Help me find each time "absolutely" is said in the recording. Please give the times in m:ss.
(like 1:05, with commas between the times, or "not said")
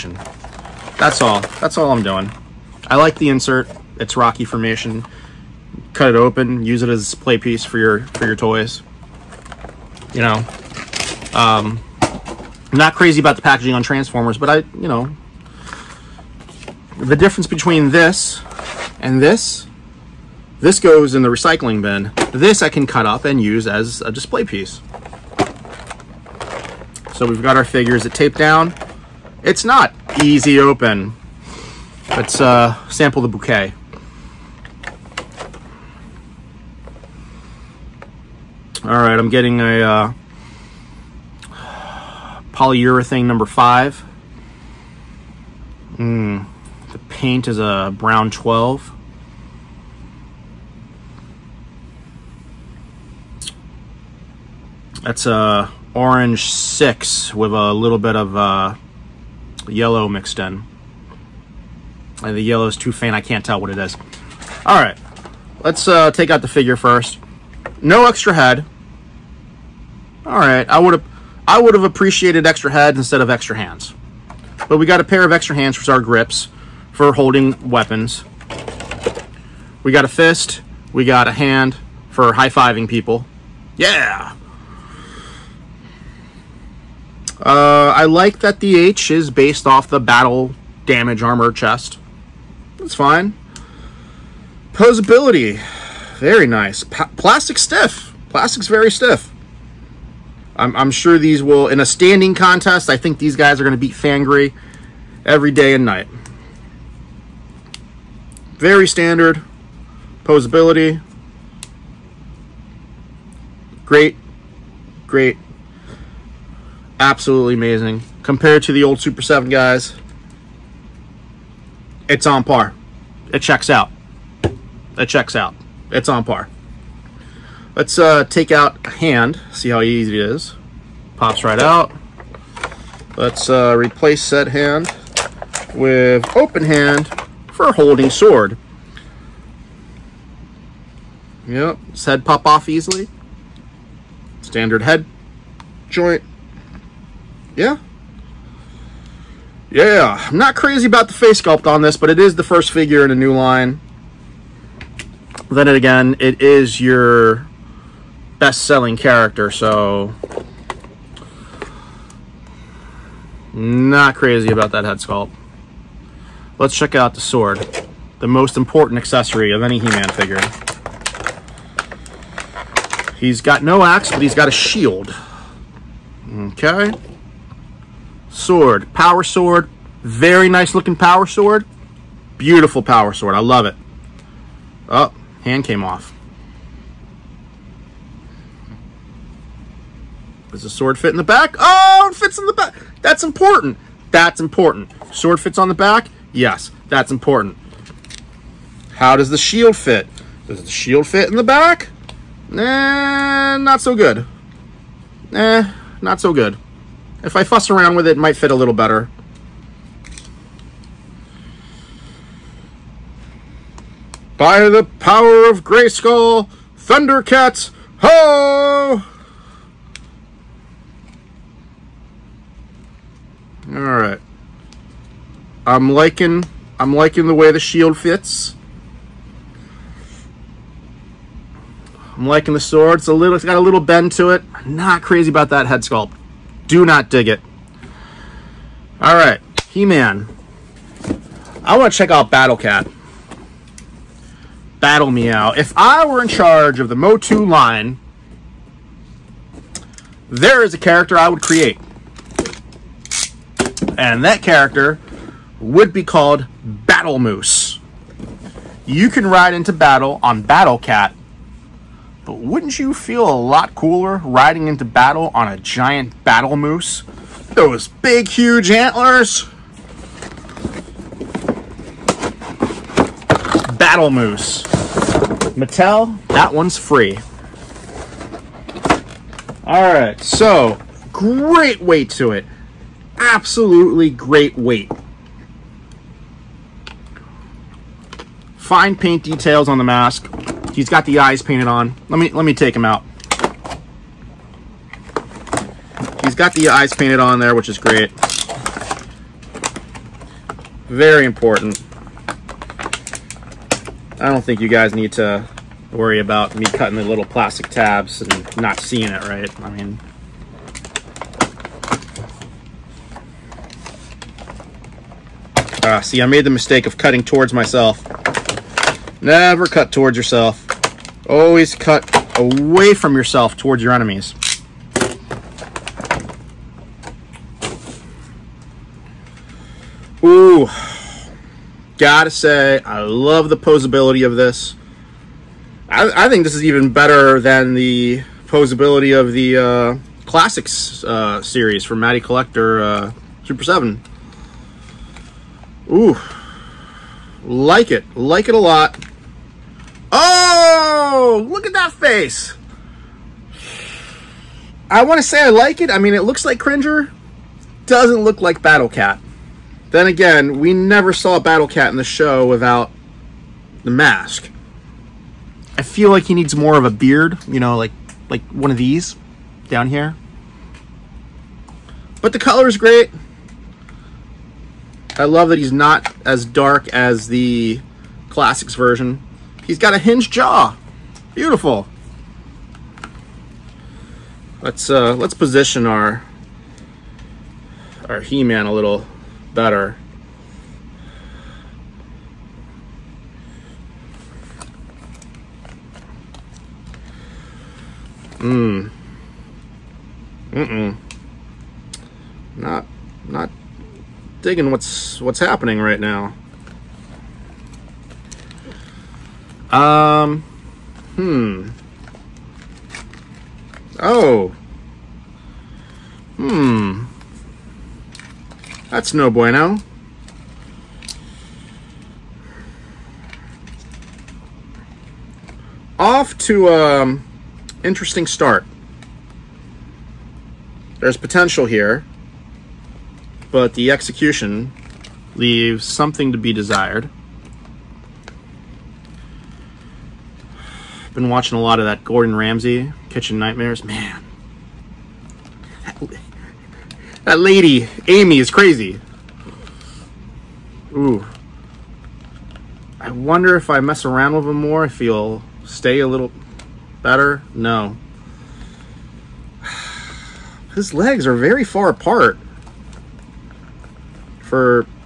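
1:56, 4:43.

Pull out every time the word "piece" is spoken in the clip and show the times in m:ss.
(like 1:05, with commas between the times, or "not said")
0:07, 0:24.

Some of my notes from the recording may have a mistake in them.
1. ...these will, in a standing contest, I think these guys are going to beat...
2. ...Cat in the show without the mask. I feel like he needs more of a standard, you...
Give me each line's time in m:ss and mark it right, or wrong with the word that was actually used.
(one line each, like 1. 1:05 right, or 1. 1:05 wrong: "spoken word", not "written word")
1. 1:41 right
2. 6:01 wrong: "beard", not "standard".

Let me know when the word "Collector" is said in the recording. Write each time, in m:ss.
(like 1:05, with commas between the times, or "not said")
5:42.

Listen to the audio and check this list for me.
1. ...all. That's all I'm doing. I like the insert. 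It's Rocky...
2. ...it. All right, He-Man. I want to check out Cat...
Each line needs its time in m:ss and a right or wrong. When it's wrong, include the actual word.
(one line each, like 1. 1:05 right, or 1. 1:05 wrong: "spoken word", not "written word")
1. 0:01 right
2. 3:57 wrong: "Battle", not "Cat".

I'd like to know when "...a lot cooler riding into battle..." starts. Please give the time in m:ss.
4:23.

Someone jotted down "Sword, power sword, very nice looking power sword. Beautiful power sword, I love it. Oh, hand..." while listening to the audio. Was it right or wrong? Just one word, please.
right.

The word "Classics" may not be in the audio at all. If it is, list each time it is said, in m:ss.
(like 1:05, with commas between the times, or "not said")
5:40, 6:18.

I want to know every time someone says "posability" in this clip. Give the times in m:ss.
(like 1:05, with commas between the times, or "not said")
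1:34, 1:50, 5:33, 5:38.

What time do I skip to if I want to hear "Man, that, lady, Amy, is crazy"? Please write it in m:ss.
7:23.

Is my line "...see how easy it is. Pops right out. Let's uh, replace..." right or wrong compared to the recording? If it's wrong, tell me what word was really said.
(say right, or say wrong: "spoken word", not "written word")
right.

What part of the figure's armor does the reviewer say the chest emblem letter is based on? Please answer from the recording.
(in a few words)
battle damage armor chest.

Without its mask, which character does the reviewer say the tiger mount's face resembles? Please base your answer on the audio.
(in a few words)
Cringer.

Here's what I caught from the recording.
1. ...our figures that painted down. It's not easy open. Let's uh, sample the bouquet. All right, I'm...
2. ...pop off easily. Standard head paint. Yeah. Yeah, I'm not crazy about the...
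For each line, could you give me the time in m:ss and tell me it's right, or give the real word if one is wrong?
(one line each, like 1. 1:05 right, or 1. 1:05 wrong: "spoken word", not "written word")
1. 0:27 wrong: "taped", not "painted"
2. 2:22 wrong: "joint", not "paint".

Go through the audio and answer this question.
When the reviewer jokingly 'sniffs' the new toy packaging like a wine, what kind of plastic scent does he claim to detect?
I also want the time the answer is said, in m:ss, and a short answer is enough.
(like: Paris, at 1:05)
polyurethane number five, at 0:42.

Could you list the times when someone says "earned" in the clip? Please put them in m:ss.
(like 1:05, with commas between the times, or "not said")
not said.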